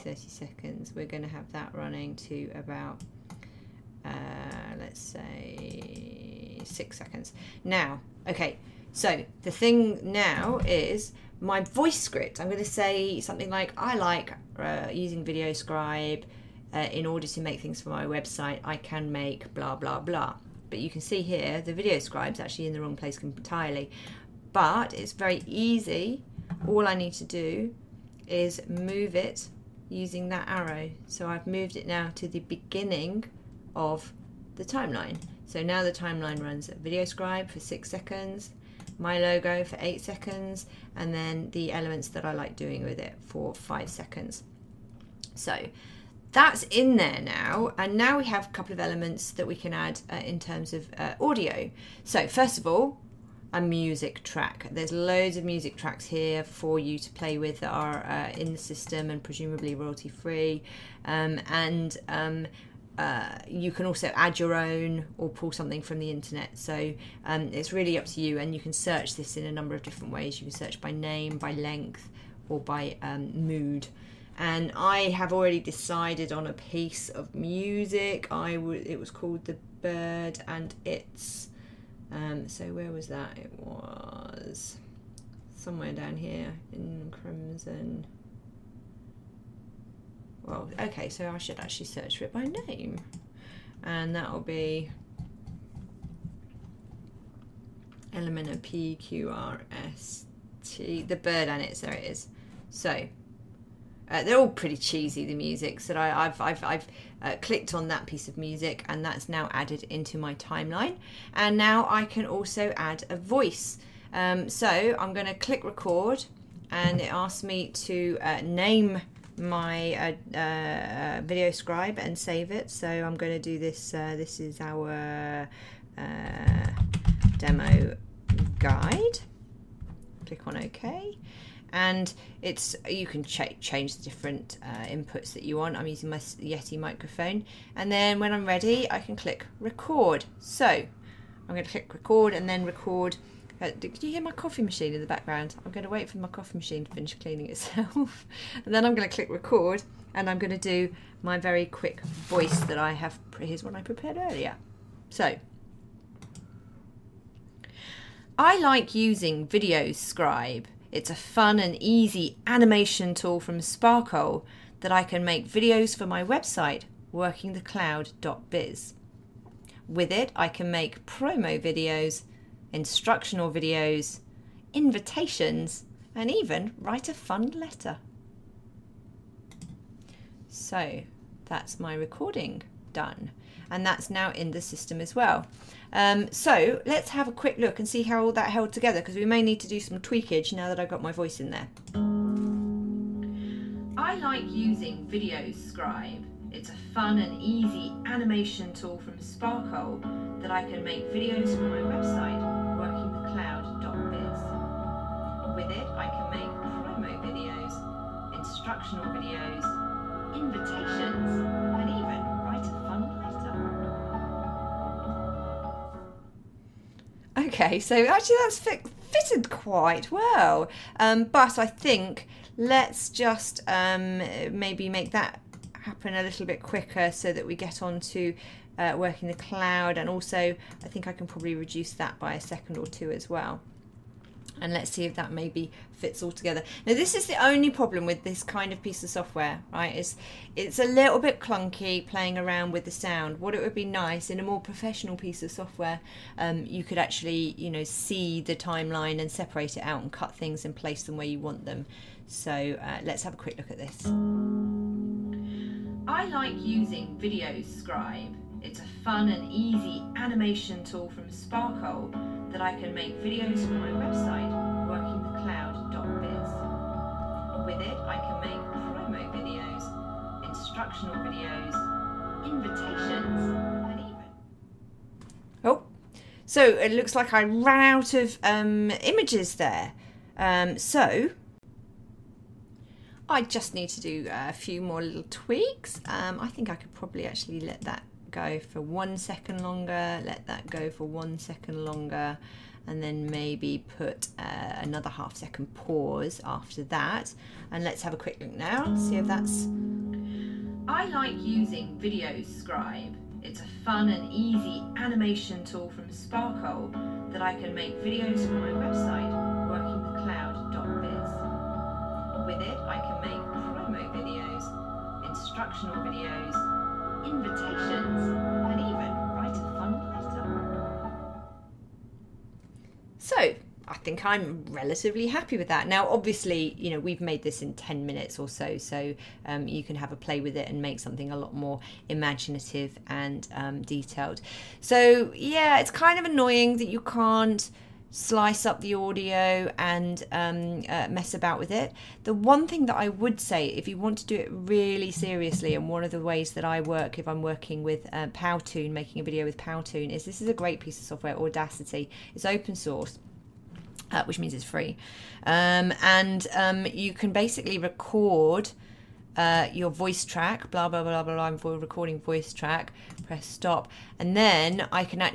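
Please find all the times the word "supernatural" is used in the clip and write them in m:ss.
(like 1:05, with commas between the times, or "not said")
not said.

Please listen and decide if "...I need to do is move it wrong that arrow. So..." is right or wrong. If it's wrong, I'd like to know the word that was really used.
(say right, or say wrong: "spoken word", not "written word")
wrong: "using", not "wrong".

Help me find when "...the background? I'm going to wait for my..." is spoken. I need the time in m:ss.
2:24.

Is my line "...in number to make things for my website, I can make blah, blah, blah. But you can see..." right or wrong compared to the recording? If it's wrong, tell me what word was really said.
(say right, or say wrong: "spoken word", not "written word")
wrong: "order", not "number".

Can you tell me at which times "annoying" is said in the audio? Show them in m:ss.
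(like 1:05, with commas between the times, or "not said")
5:36.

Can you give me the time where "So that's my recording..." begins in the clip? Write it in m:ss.
3:00.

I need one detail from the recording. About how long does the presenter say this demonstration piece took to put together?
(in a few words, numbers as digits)
10 minutes.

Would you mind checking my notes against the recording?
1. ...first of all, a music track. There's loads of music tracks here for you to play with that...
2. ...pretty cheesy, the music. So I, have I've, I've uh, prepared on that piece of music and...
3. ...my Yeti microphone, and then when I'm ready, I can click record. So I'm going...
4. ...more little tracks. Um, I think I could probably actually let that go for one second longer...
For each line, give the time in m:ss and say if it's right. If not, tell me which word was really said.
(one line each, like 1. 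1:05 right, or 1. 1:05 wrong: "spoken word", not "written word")
1. 0:52 right
2. 1:44 wrong: "clicked", not "prepared"
3. 2:16 right
4. 4:44 wrong: "tweaks", not "tracks".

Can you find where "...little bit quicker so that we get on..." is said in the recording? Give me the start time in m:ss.
3:46.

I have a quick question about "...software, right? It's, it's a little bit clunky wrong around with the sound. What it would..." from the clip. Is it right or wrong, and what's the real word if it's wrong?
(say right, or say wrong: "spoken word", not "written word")
wrong: "playing", not "wrong".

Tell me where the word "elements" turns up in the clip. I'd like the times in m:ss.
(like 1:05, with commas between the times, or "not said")
0:41, 0:48.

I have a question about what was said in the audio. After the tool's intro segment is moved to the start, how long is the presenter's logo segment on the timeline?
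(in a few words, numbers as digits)
8 seconds.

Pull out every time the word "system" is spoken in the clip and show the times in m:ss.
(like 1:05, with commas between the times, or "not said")
0:58, 3:04.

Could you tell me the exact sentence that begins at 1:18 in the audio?
I w- it was called The Bird and It's.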